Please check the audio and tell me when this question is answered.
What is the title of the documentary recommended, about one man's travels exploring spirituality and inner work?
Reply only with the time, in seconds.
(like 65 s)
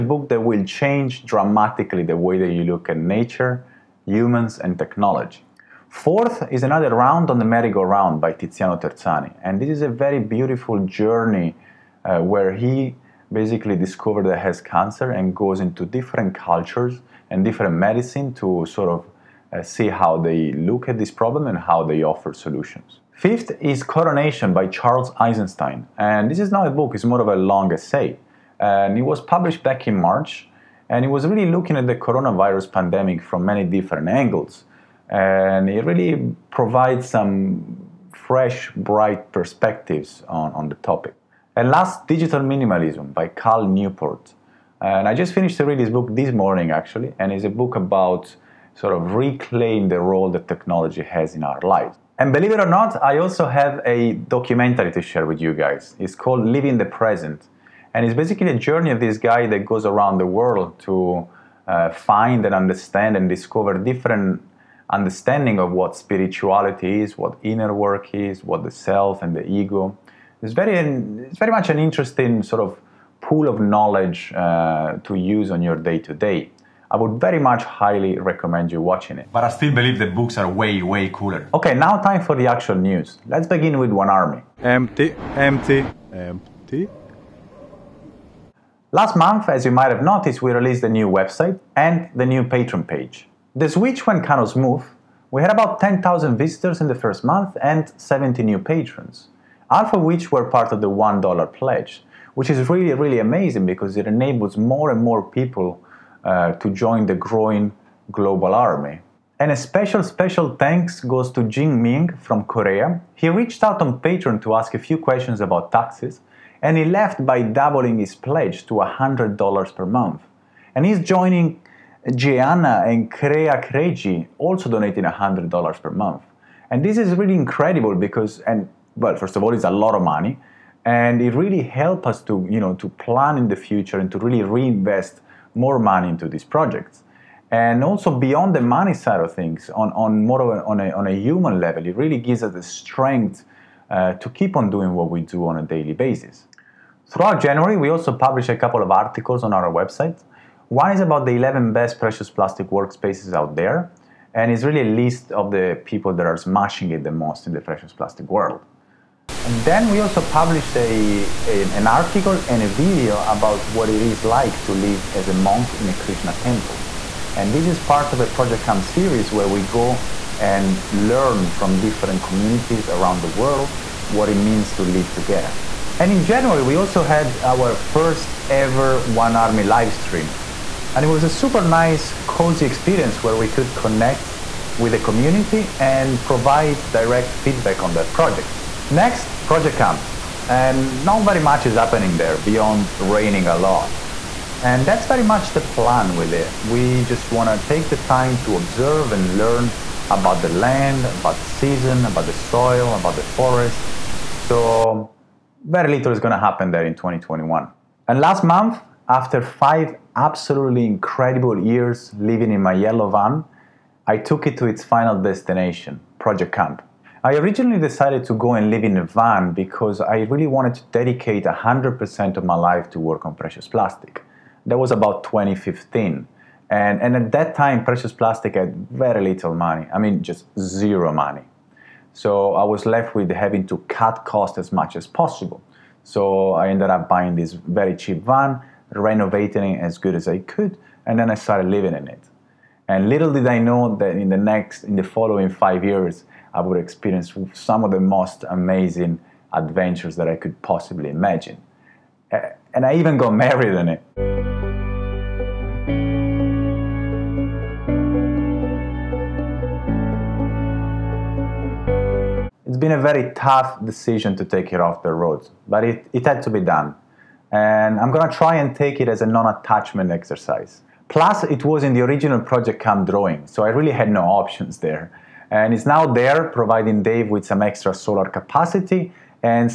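56 s.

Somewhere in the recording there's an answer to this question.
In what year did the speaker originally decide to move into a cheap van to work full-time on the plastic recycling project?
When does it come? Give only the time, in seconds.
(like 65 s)
225 s.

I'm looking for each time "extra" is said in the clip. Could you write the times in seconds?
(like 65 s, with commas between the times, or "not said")
277 s.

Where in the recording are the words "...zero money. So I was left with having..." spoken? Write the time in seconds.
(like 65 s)
230 s.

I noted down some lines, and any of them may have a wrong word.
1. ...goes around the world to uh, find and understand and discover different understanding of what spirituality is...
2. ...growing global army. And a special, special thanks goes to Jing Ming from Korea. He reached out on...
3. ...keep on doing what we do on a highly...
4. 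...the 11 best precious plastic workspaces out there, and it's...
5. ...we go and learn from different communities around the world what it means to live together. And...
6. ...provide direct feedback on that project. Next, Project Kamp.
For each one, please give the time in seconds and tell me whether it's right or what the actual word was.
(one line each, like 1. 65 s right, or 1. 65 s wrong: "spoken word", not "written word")
1. 59 s right
2. 107 s right
3. 144 s wrong: "daily", not "highly"
4. 151 s right
5. 169 s right
6. 186 s right.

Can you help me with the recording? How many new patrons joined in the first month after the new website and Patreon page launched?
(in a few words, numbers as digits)
70.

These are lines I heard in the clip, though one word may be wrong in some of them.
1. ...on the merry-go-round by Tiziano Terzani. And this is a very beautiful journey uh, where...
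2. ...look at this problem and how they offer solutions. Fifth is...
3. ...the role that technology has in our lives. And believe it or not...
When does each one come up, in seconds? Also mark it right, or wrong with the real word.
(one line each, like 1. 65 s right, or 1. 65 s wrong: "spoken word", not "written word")
1. 7 s right
2. 20 s right
3. 49 s right.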